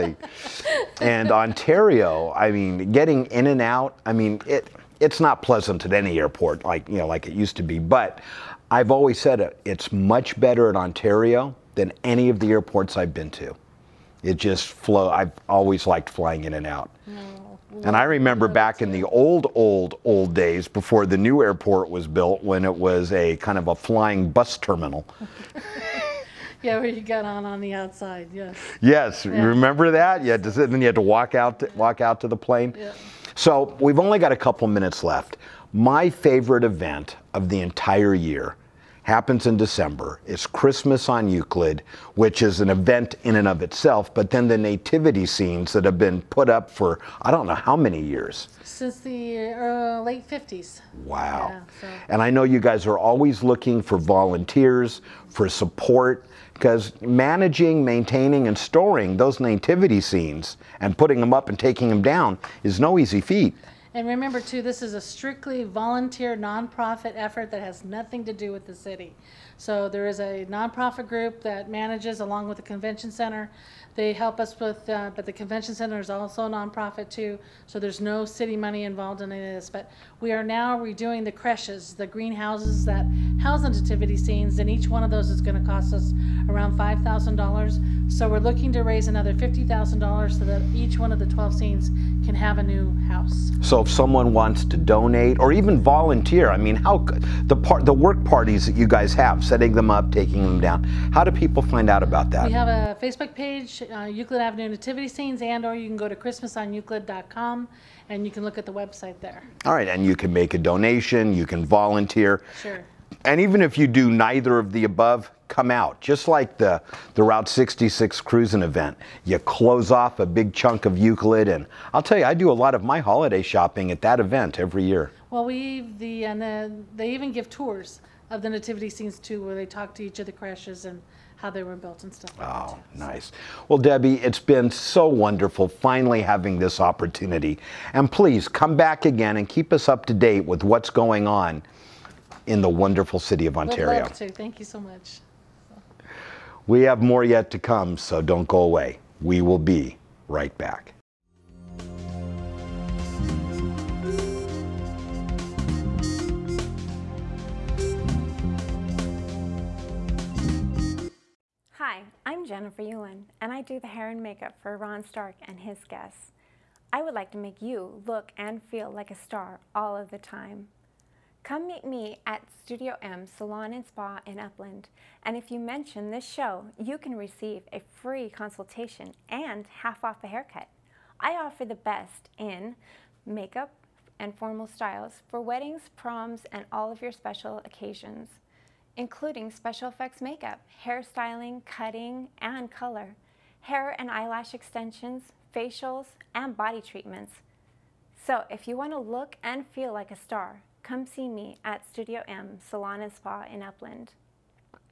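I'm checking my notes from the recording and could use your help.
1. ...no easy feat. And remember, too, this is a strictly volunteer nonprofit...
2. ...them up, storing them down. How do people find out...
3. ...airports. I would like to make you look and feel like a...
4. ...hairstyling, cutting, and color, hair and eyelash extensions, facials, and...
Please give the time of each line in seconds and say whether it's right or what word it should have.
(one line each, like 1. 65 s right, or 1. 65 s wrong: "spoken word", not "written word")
1. 62 s right
2. 99 s wrong: "taking", not "storing"
3. 165 s wrong: "guests", not "airports"
4. 190 s right.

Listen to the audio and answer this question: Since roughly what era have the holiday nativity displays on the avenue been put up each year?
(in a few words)
late 50s.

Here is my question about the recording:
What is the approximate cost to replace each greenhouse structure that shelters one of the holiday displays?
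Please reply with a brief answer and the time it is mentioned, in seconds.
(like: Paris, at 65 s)
$5,000, at 86 s.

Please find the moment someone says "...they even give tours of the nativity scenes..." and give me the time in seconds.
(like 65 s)
126 s.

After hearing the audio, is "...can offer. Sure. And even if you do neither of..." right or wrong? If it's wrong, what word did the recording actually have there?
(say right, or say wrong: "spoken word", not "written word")
wrong: "volunteer", not "offer".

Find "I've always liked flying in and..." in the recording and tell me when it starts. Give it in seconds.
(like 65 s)
15 s.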